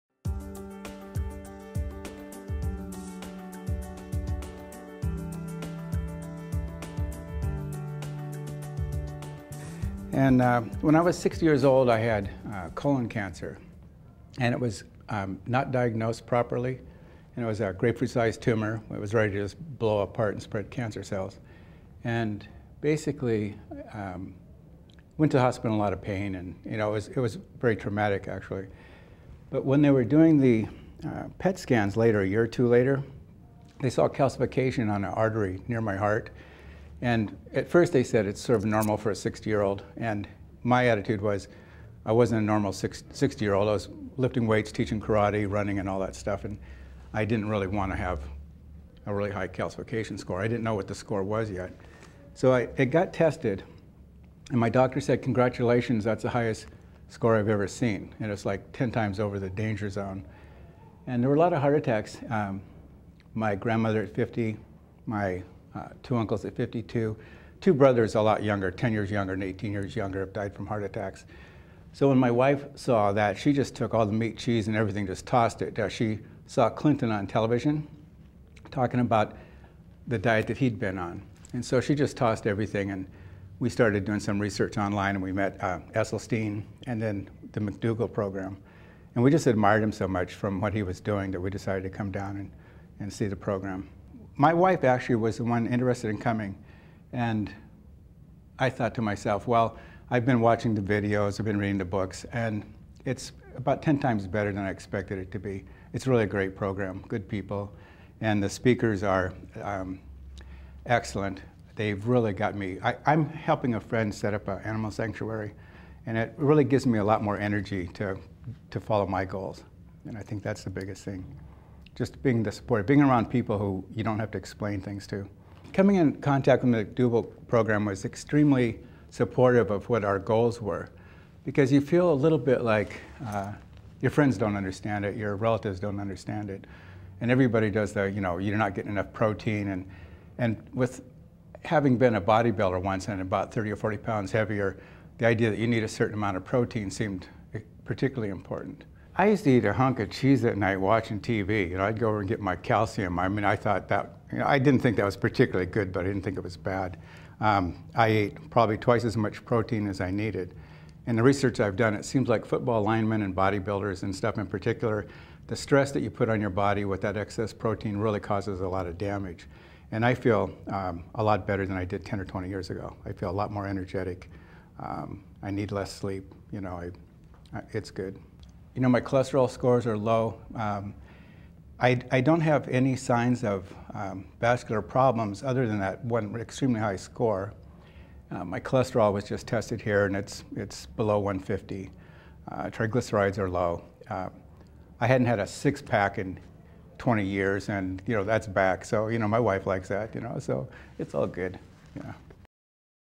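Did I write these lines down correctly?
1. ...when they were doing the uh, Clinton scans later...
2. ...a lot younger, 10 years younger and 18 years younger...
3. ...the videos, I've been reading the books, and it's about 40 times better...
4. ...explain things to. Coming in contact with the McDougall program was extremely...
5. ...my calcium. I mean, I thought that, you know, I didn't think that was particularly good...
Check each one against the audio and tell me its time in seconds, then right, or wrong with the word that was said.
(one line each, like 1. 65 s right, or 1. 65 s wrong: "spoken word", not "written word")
1. 29 s wrong: "PET", not "Clinton"
2. 68 s right
3. 100 s wrong: "10", not "40"
4. 124 s right
5. 152 s right.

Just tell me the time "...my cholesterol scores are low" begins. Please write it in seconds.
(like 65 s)
178 s.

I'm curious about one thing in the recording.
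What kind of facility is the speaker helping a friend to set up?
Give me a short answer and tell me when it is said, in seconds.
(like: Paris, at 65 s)
an animal sanctuary, at 114 s.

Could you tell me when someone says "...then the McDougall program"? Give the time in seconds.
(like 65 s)
87 s.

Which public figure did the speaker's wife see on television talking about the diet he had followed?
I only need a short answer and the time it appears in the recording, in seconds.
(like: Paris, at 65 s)
Clinton, at 76 s.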